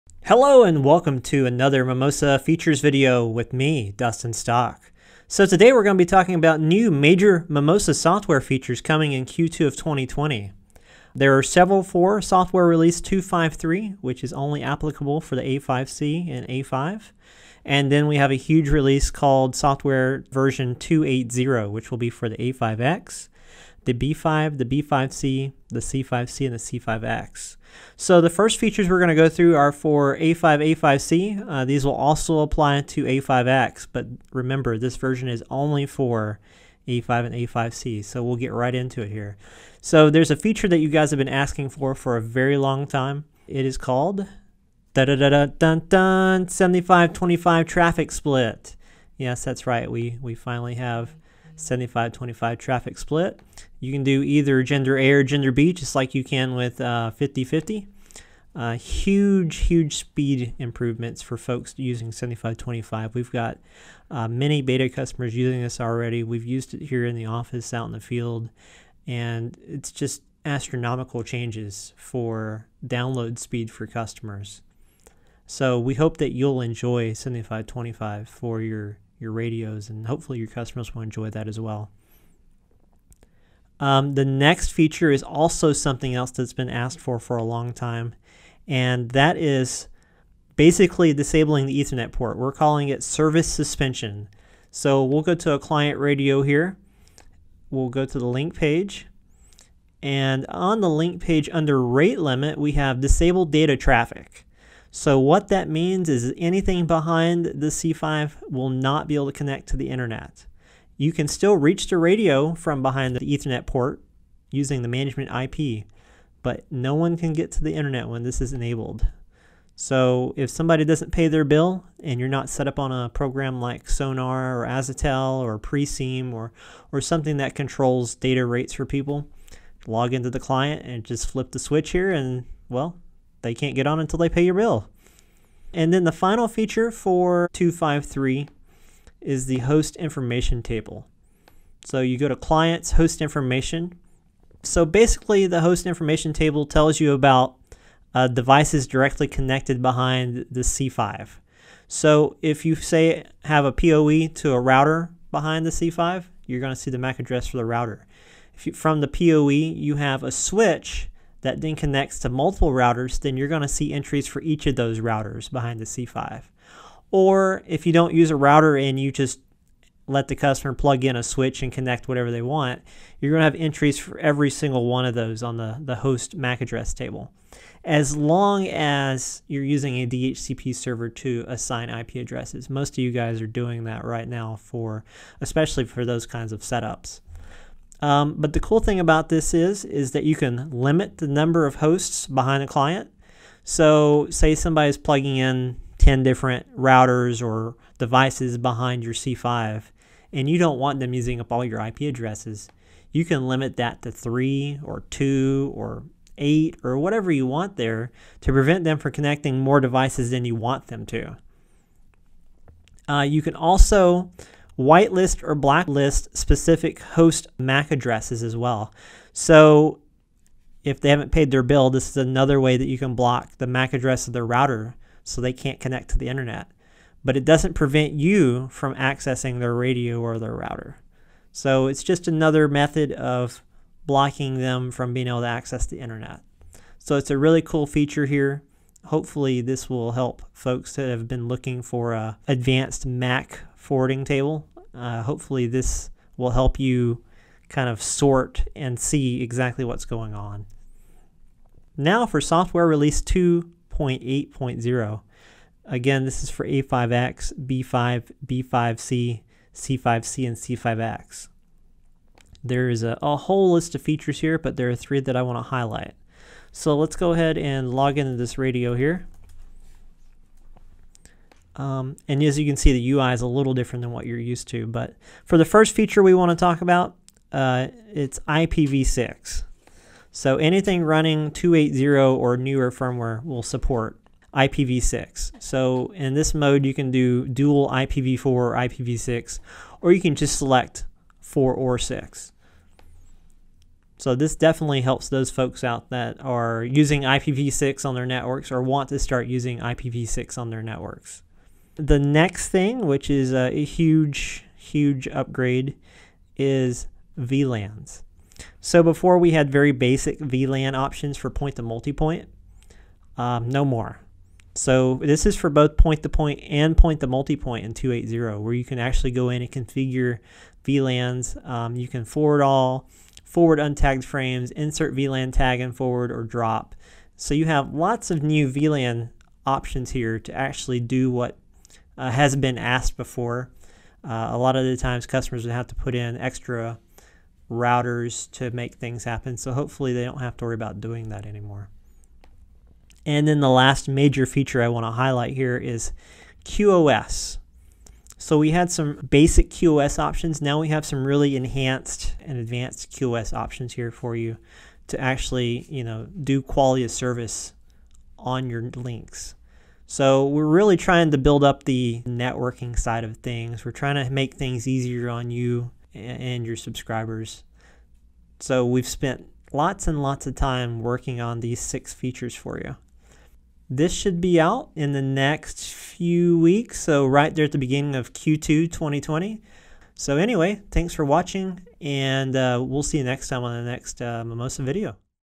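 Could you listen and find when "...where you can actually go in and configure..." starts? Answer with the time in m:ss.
5:18.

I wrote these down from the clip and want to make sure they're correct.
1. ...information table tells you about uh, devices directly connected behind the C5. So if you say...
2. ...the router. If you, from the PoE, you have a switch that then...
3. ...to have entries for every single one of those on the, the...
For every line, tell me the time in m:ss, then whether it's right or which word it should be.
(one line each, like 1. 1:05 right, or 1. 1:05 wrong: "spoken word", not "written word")
1. 2:25 right
2. 2:37 right
3. 2:53 right.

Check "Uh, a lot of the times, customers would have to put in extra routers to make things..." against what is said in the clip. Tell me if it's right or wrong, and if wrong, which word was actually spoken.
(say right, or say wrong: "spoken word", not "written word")
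right.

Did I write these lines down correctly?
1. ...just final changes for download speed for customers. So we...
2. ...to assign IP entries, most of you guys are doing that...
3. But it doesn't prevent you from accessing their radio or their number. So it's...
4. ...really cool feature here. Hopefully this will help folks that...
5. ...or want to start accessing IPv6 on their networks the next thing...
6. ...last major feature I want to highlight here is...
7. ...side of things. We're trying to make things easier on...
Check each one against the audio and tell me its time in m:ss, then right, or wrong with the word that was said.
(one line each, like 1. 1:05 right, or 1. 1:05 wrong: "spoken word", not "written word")
1. 1:09 wrong: "astronomical", not "final"
2. 3:01 wrong: "addresses", not "entries"
3. 3:47 wrong: "router", not "number"
4. 3:57 right
5. 4:58 wrong: "using", not "accessing"
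6. 5:43 right
7. 6:02 right.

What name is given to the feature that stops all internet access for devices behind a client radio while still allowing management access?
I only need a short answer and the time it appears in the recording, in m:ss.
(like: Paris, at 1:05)
Service suspension, at 1:33.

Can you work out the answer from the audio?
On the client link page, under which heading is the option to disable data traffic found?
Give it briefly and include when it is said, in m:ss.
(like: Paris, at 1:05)
Rate limit, at 1:41.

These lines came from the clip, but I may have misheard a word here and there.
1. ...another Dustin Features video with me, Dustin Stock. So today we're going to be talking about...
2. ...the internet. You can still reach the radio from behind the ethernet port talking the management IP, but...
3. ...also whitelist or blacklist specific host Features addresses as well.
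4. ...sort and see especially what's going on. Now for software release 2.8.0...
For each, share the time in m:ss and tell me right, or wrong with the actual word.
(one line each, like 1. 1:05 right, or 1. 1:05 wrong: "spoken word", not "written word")
1. 0:01 wrong: "Mimosa", not "Dustin"
2. 1:49 wrong: "using", not "talking"
3. 3:33 wrong: "MAC", not "Features"
4. 4:08 wrong: "exactly", not "especially".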